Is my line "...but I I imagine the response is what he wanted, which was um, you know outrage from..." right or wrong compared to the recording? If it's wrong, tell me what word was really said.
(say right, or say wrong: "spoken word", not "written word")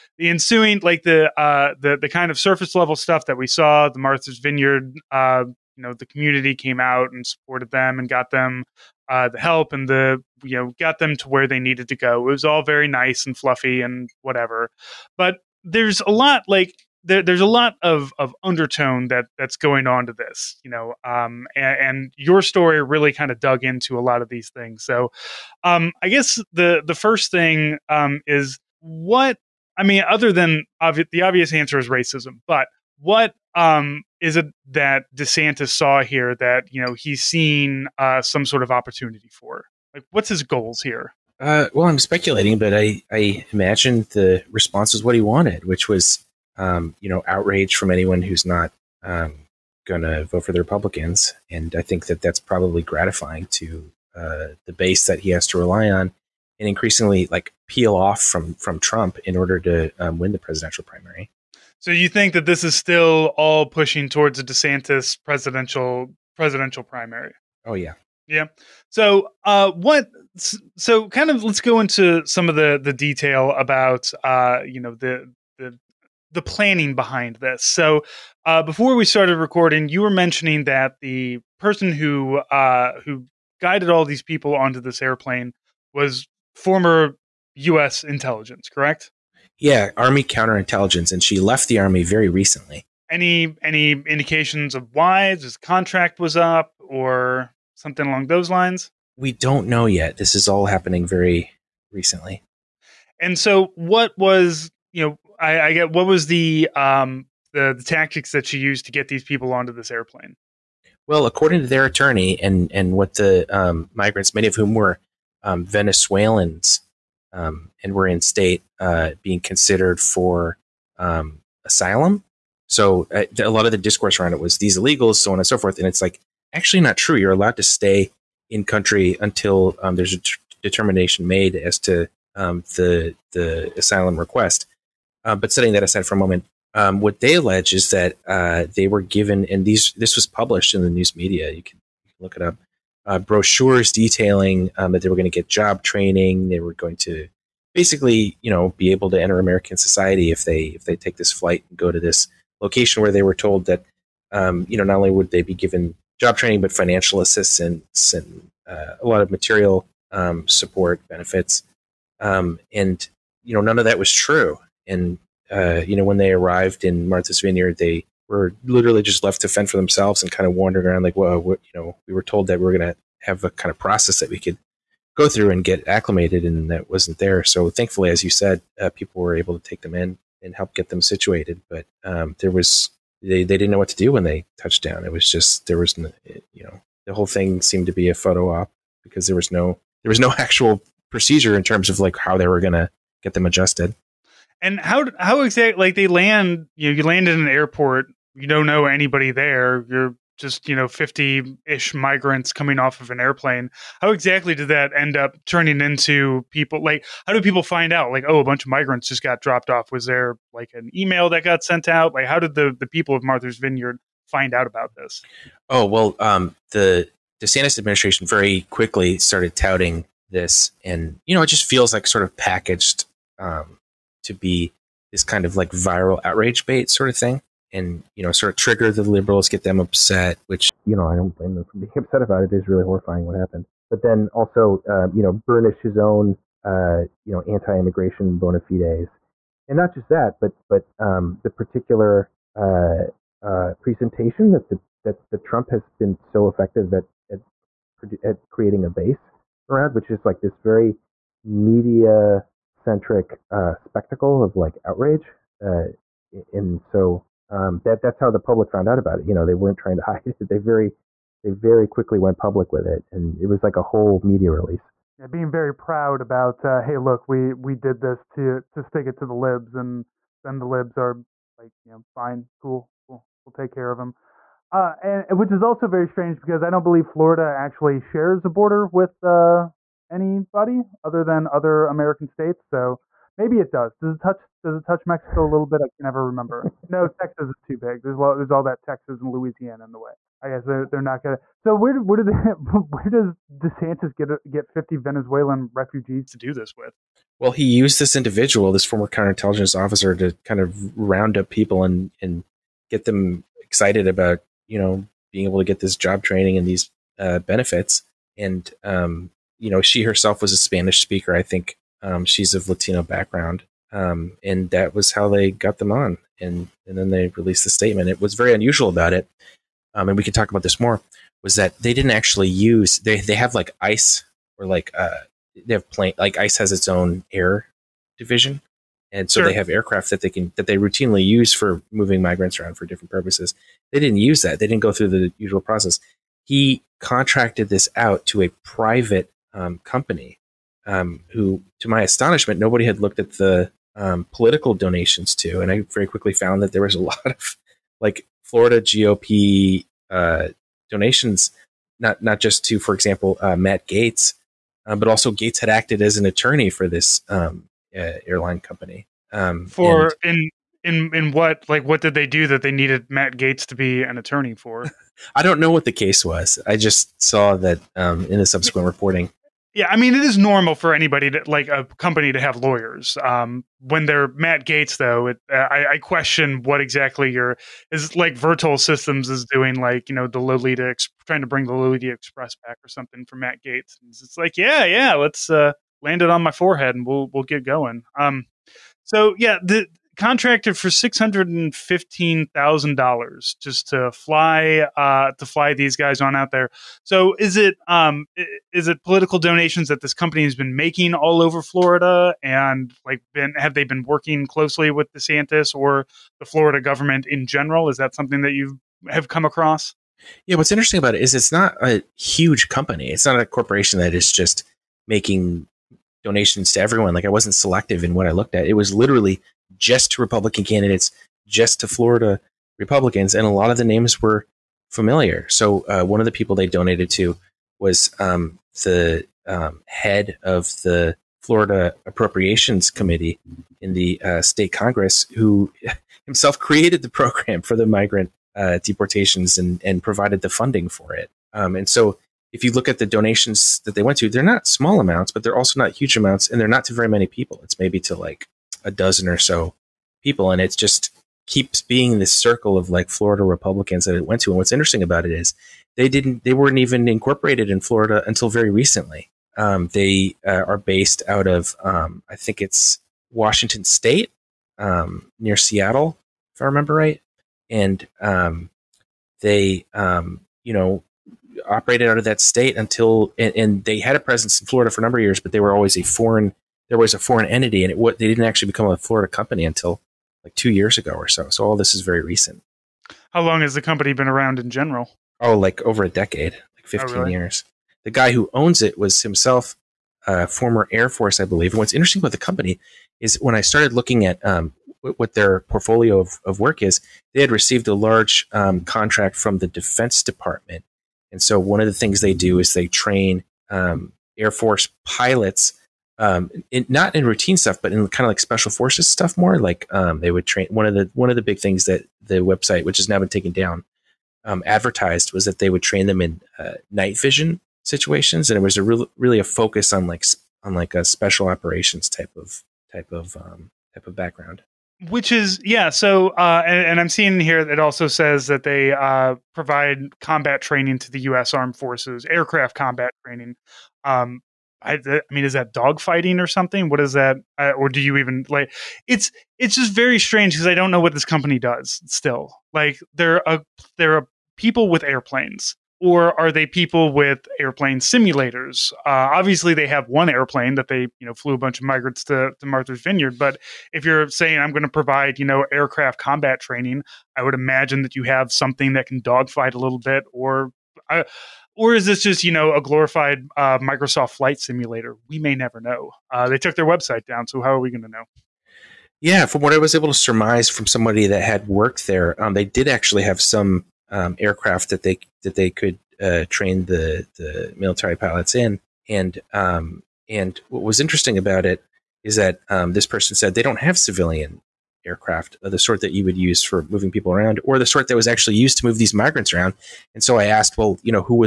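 right.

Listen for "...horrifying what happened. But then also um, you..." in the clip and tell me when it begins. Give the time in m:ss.
3:52.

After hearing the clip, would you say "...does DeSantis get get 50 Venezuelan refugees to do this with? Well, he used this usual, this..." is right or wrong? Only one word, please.
wrong.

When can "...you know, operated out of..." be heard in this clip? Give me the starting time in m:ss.
7:50.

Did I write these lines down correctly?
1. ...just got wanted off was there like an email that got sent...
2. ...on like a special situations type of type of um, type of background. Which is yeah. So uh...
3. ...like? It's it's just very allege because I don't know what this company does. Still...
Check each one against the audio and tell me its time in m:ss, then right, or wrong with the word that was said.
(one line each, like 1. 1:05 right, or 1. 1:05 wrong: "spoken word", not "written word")
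1. 3:29 wrong: "dropped", not "wanted"
2. 8:40 wrong: "operations", not "situations"
3. 8:58 wrong: "strange", not "allege".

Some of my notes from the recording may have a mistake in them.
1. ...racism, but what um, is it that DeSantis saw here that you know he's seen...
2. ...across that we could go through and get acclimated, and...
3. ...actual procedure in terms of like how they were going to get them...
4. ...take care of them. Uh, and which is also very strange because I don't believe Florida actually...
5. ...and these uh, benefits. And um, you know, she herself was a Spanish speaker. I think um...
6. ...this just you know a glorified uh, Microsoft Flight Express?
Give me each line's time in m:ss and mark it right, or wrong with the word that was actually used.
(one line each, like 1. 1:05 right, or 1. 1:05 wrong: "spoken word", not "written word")
1. 0:31 right
2. 2:53 wrong: "process", not "across"
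3. 3:10 right
4. 4:33 right
5. 5:06 right
6. 9:22 wrong: "Simulator", not "Express".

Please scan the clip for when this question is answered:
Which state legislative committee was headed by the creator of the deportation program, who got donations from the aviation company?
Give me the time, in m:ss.
7:11.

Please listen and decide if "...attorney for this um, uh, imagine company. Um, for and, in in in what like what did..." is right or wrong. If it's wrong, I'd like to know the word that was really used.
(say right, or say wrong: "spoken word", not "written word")
wrong: "airline", not "imagine".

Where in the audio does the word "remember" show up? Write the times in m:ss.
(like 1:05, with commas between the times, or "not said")
4:46, 7:46.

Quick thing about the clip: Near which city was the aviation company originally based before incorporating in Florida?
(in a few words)
Seattle.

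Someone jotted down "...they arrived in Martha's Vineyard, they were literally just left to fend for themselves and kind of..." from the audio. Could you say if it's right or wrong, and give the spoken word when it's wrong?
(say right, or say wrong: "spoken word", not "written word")
right.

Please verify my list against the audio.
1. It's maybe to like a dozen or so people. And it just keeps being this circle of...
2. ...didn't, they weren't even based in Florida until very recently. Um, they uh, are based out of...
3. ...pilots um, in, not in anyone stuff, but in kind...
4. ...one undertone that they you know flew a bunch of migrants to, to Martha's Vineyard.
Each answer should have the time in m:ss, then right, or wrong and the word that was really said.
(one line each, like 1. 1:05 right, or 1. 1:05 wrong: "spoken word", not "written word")
1. 7:27 right
2. 7:36 wrong: "incorporated", not "based"
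3. 8:25 wrong: "routine", not "anyone"
4. 9:10 wrong: "airplane", not "undertone".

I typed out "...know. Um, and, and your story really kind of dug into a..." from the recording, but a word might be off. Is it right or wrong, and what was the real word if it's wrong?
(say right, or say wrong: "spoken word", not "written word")
right.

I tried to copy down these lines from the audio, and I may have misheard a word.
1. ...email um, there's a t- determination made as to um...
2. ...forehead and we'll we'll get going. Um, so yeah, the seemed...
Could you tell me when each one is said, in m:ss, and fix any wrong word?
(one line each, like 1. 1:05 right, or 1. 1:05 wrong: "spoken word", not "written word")
1. 2:09 wrong: "until", not "email"
2. 6:26 wrong: "contracted", not "seemed".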